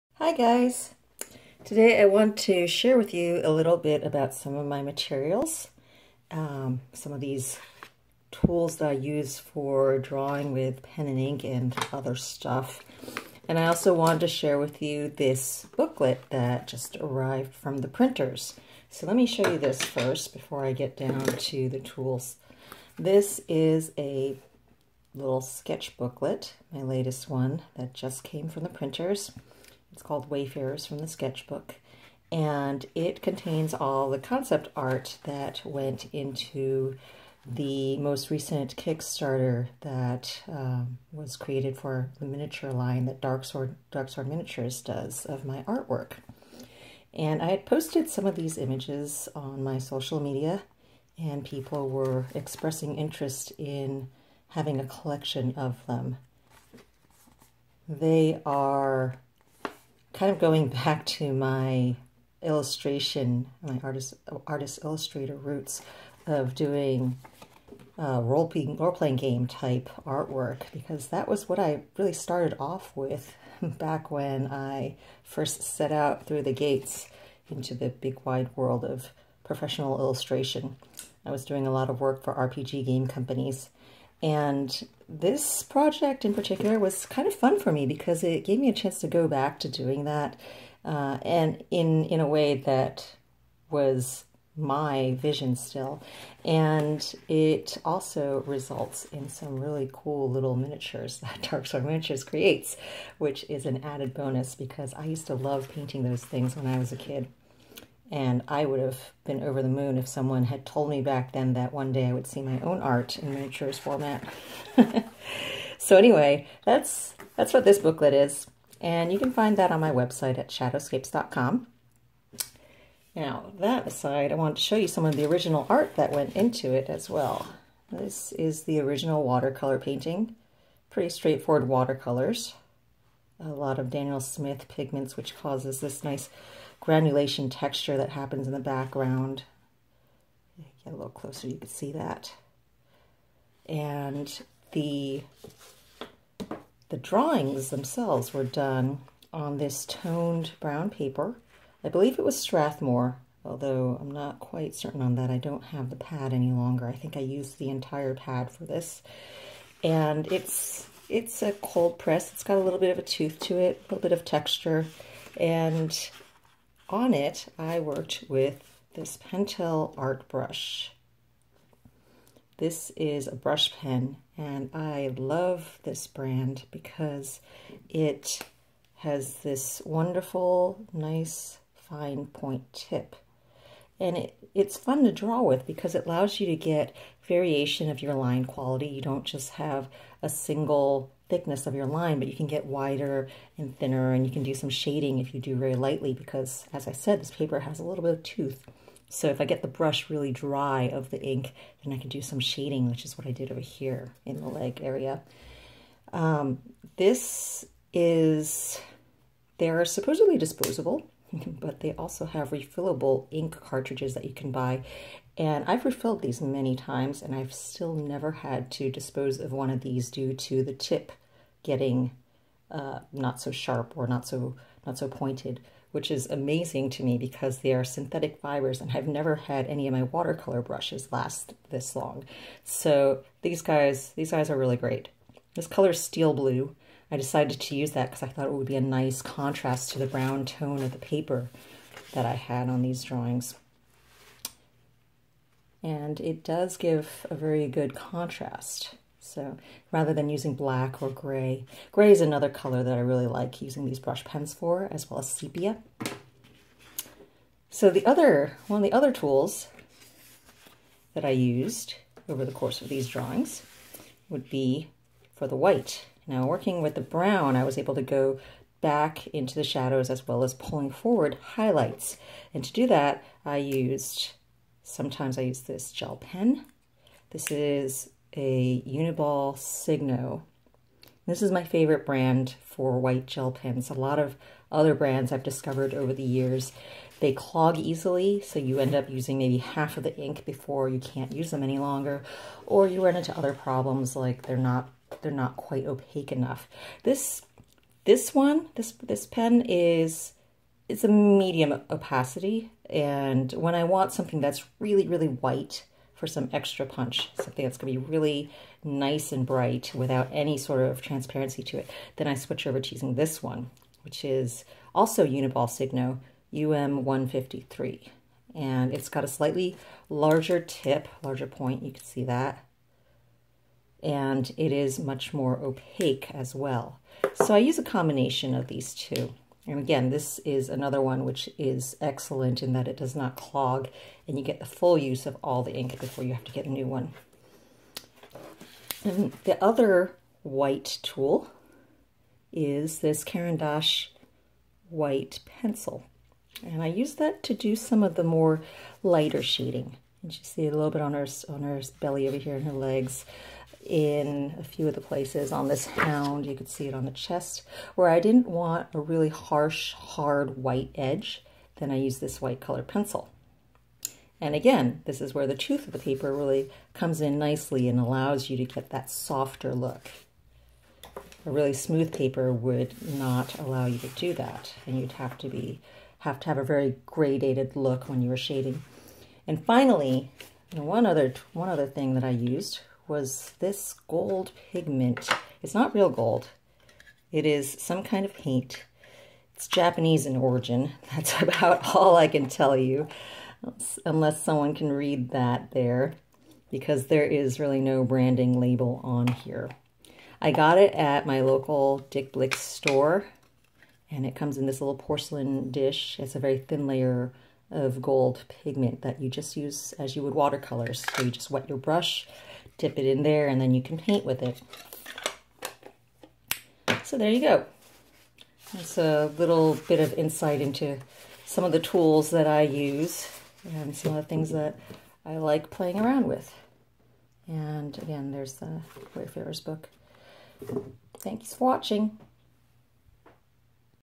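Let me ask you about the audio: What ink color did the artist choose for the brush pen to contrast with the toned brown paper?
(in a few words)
Steel blue.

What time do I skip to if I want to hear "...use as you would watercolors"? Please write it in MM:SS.
06:49.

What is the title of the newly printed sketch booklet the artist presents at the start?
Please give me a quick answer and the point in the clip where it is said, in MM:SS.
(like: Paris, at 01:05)
Wayfarers from the Sketchbook, at 00:30.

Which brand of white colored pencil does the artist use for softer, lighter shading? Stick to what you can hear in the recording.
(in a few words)
Caran d'Ache.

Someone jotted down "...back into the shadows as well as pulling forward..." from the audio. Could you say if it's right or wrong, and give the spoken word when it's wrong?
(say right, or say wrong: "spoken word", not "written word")
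right.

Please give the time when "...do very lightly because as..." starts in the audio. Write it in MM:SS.
03:15.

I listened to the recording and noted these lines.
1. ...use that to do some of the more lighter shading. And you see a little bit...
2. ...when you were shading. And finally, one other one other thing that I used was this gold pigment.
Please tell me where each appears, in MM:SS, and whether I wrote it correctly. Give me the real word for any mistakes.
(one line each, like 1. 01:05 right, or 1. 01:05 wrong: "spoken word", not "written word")
1. 05:46 right
2. 06:18 right.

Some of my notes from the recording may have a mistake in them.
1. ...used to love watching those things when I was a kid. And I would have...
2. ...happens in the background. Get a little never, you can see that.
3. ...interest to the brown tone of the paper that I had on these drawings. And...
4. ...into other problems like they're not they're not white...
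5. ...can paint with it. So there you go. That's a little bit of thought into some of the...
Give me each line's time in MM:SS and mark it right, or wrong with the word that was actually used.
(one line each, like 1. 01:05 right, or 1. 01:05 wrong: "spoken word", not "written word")
1. 01:45 wrong: "painting", not "watching"
2. 02:18 wrong: "closer", not "never"
3. 03:59 wrong: "contrast", not "interest"
4. 04:53 wrong: "quite", not "white"
5. 06:53 wrong: "insight", not "thought".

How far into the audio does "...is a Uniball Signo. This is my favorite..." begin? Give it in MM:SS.
04:37.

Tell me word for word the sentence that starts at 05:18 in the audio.
And it's got a slightly larger tip, larger point, you can see that and it is much more opaque as well.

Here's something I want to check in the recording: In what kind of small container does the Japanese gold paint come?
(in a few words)
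Porcelain dish.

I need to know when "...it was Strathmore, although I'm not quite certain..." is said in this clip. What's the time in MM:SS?
02:32.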